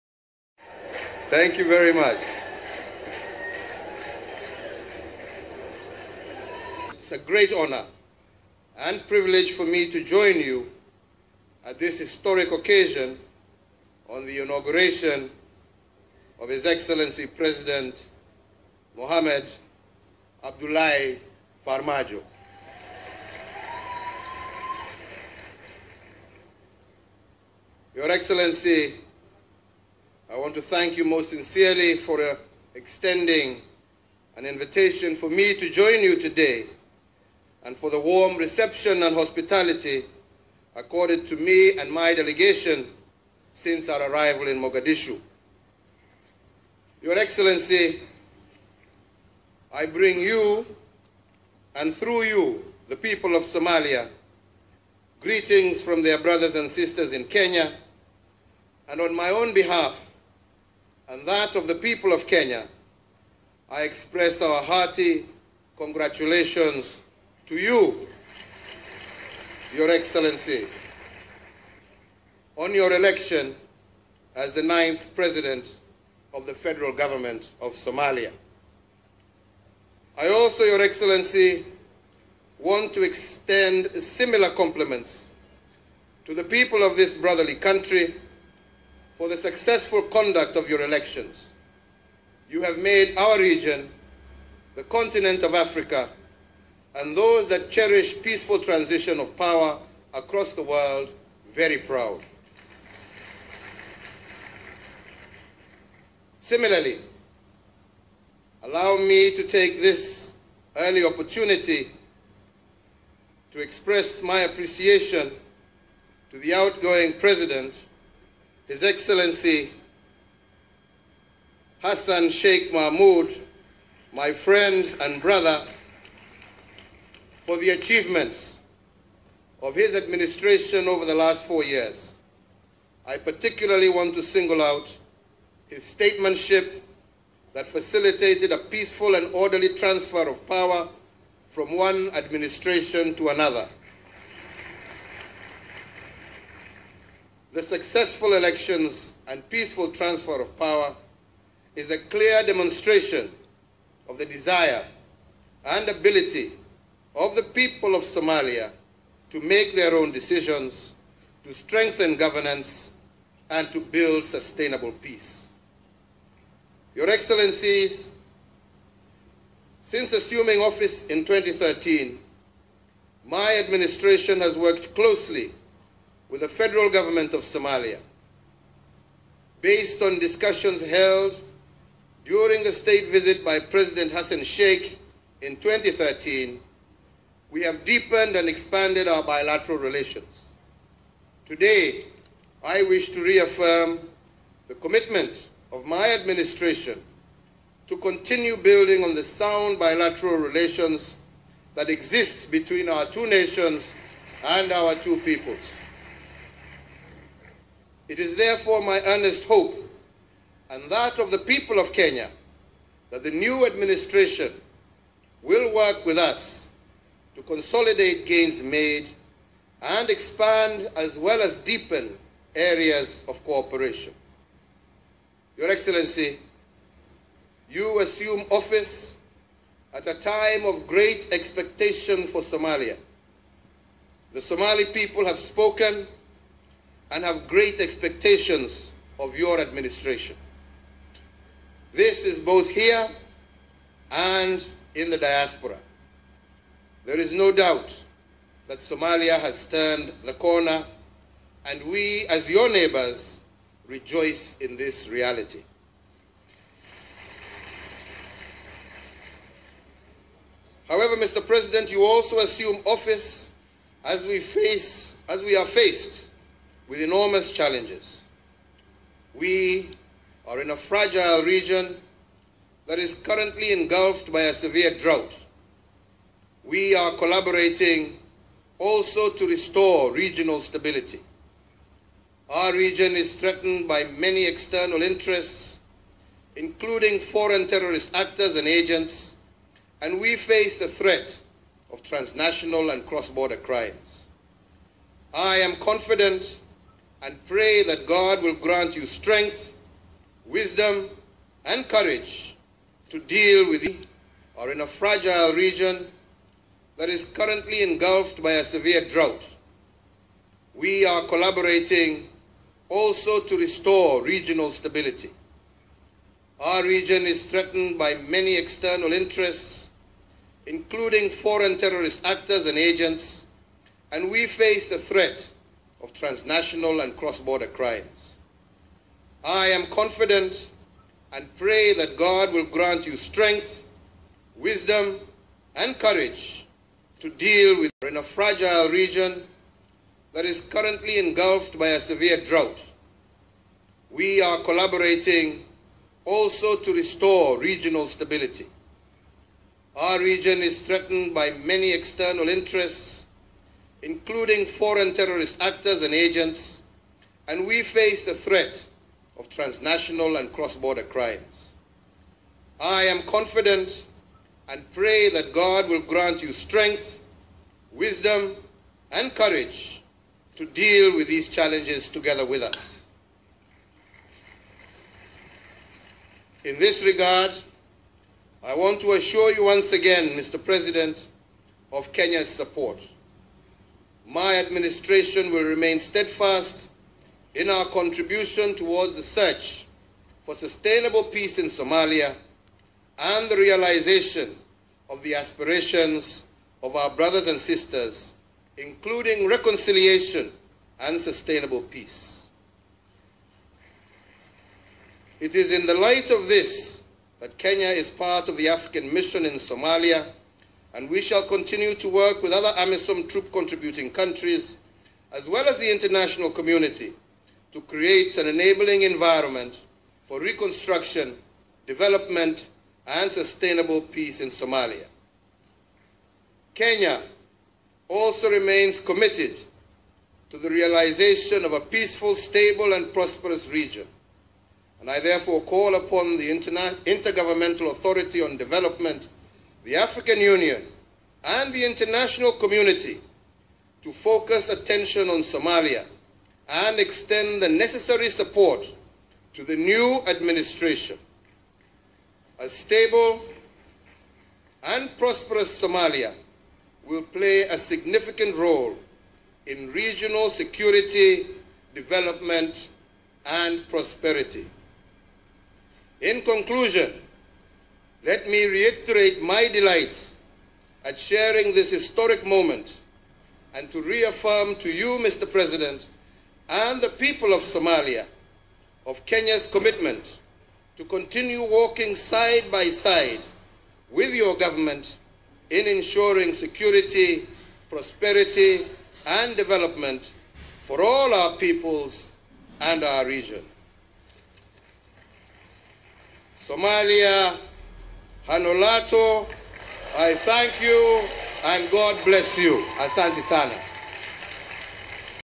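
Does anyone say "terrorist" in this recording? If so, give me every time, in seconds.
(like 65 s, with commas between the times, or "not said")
287 s, 321 s, 355 s.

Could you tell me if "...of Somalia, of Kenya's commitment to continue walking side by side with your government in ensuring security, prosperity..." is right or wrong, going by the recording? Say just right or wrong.
right.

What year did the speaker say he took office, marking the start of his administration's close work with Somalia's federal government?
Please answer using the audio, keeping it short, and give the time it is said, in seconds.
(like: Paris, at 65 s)
2013, at 169 s.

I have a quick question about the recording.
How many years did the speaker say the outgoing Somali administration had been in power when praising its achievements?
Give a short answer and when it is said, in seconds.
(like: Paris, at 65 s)
4, at 131 s.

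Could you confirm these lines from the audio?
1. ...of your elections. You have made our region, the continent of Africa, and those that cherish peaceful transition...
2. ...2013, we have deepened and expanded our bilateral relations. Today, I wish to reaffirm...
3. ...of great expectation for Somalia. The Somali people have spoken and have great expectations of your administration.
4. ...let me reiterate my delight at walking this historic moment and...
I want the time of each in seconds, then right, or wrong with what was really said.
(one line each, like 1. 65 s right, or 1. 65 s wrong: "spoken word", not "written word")
1. 90 s right
2. 185 s right
3. 230 s right
4. 468 s wrong: "sharing", not "walking".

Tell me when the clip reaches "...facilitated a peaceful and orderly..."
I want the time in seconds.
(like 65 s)
137 s.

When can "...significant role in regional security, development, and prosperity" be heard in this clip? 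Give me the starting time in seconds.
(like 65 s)
457 s.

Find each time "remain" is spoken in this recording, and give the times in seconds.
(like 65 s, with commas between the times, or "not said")
385 s, 428 s.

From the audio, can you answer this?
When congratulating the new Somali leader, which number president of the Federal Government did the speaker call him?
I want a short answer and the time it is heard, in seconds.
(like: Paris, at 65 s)
ninth, at 74 s.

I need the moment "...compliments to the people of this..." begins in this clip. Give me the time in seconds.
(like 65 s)
84 s.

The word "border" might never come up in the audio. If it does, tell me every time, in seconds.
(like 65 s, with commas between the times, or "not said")
293 s, 327 s, 360 s.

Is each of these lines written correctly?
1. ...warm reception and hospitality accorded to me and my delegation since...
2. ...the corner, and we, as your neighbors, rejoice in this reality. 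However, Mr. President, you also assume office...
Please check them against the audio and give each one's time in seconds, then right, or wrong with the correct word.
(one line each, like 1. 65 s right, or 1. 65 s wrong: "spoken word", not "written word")
1. 37 s right
2. 250 s right.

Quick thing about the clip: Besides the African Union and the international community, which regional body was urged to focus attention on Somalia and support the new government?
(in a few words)
Intergovernmental Authority on Development.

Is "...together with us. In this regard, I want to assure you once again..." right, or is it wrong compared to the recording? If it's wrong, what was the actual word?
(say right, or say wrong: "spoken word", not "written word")
right.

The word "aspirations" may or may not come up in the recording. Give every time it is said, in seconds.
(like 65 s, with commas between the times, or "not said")
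395 s.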